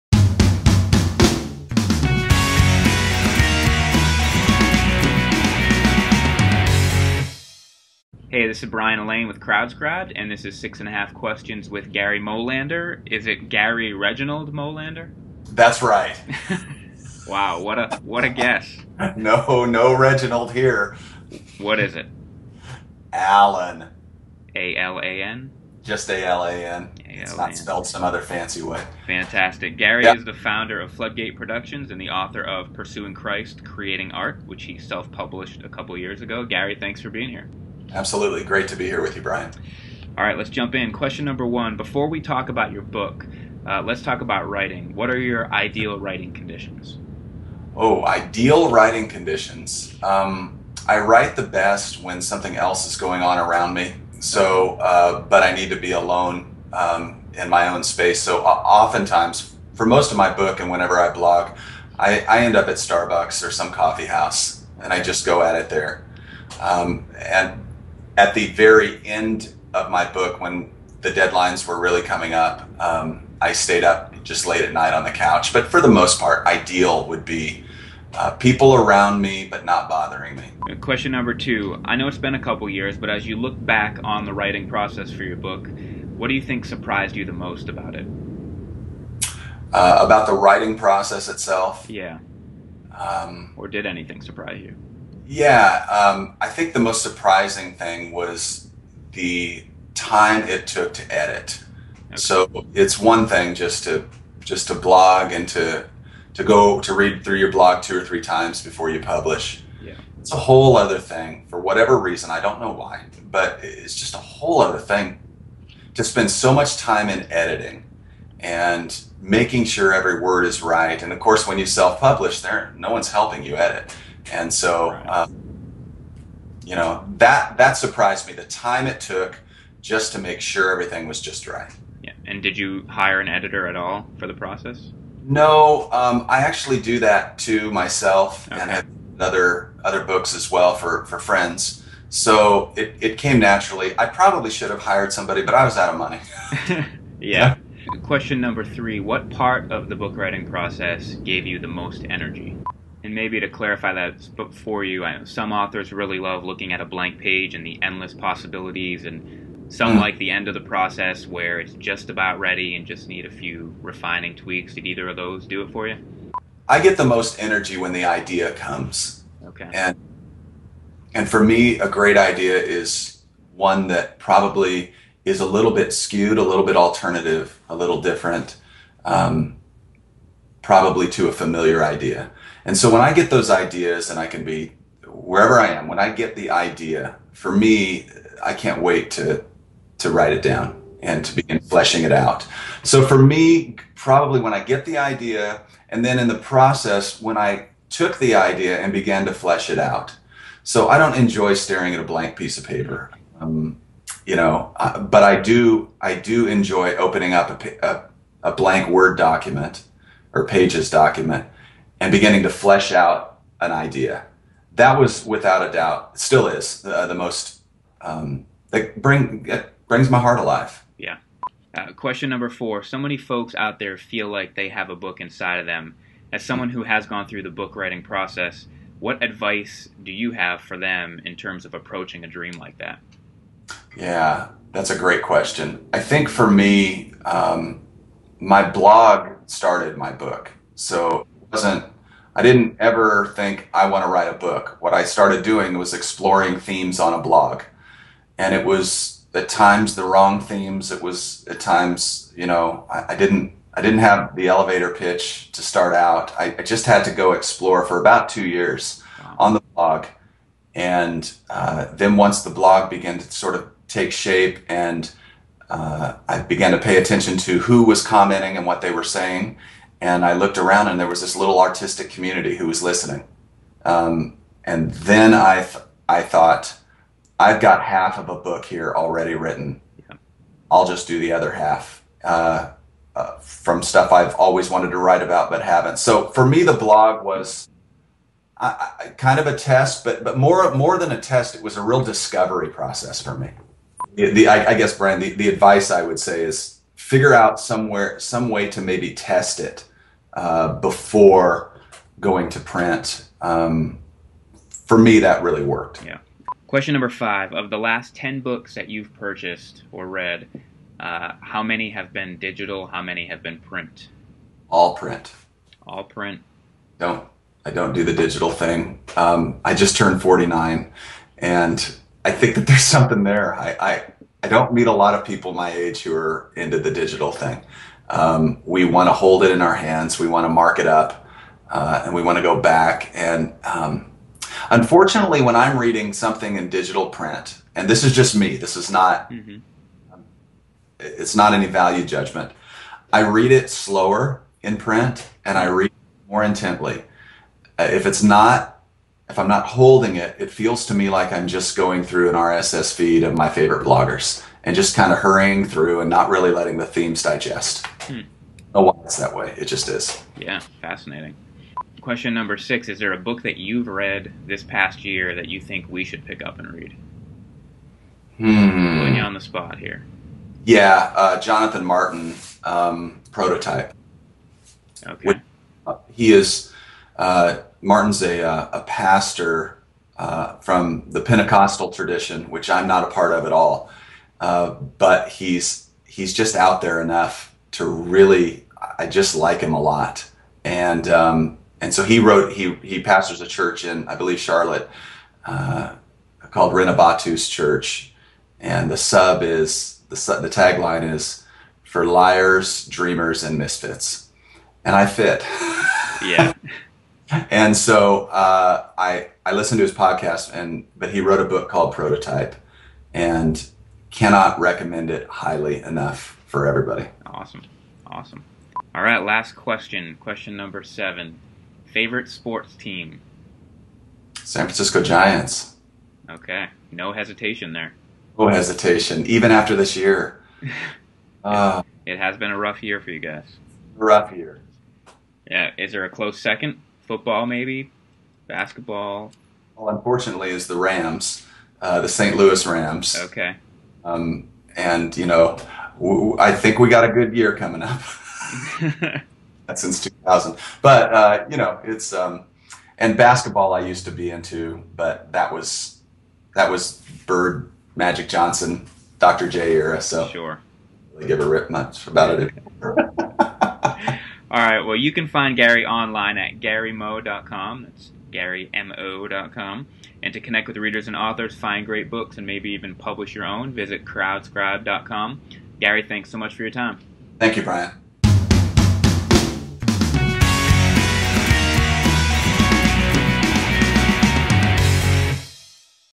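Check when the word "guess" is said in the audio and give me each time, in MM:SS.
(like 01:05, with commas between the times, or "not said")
00:18, 04:54.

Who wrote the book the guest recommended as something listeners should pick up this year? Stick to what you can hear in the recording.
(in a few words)
Jonathan Martin.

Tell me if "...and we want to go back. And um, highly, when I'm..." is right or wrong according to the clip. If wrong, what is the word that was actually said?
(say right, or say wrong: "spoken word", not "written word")
wrong: "unfortunately", not "highly".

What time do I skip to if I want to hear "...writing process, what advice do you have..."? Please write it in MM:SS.
03:47.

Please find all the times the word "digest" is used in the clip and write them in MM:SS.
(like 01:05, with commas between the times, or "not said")
05:57.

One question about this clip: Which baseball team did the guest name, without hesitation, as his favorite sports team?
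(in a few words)
San Francisco Giants.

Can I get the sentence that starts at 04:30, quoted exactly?
And I looked around and there was this little artistic community who was listening.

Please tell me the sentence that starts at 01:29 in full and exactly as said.
Uh, about the writing process itself?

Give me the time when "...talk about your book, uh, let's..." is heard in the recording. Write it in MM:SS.
00:42.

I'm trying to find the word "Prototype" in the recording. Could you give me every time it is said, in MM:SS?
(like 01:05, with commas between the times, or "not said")
06:13, 06:51.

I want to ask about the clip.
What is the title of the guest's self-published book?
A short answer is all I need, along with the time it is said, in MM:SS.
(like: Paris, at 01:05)
Pursuing Christ: Creating Art, at 00:32.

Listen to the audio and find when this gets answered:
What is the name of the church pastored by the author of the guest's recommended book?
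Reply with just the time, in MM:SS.
06:36.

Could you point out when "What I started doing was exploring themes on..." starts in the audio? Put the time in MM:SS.
04:04.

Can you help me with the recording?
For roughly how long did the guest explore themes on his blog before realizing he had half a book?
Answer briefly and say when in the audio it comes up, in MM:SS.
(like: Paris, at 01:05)
2 years, at 04:18.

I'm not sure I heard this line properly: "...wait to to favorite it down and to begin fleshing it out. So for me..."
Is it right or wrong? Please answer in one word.
wrong.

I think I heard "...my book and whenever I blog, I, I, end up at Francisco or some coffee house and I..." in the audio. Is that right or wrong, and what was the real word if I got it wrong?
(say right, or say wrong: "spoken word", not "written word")
wrong: "Starbucks", not "Francisco".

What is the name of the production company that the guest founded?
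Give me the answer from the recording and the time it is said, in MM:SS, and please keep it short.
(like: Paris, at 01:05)
Floodgate Productions, at 00:30.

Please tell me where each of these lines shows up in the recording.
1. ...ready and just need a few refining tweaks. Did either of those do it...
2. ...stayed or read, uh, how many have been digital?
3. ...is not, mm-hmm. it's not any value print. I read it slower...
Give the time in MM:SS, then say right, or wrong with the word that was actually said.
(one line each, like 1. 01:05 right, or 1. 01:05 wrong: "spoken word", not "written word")
1. 02:42 right
2. 05:09 wrong: "purchased", not "stayed"
3. 05:38 wrong: "judgment", not "print".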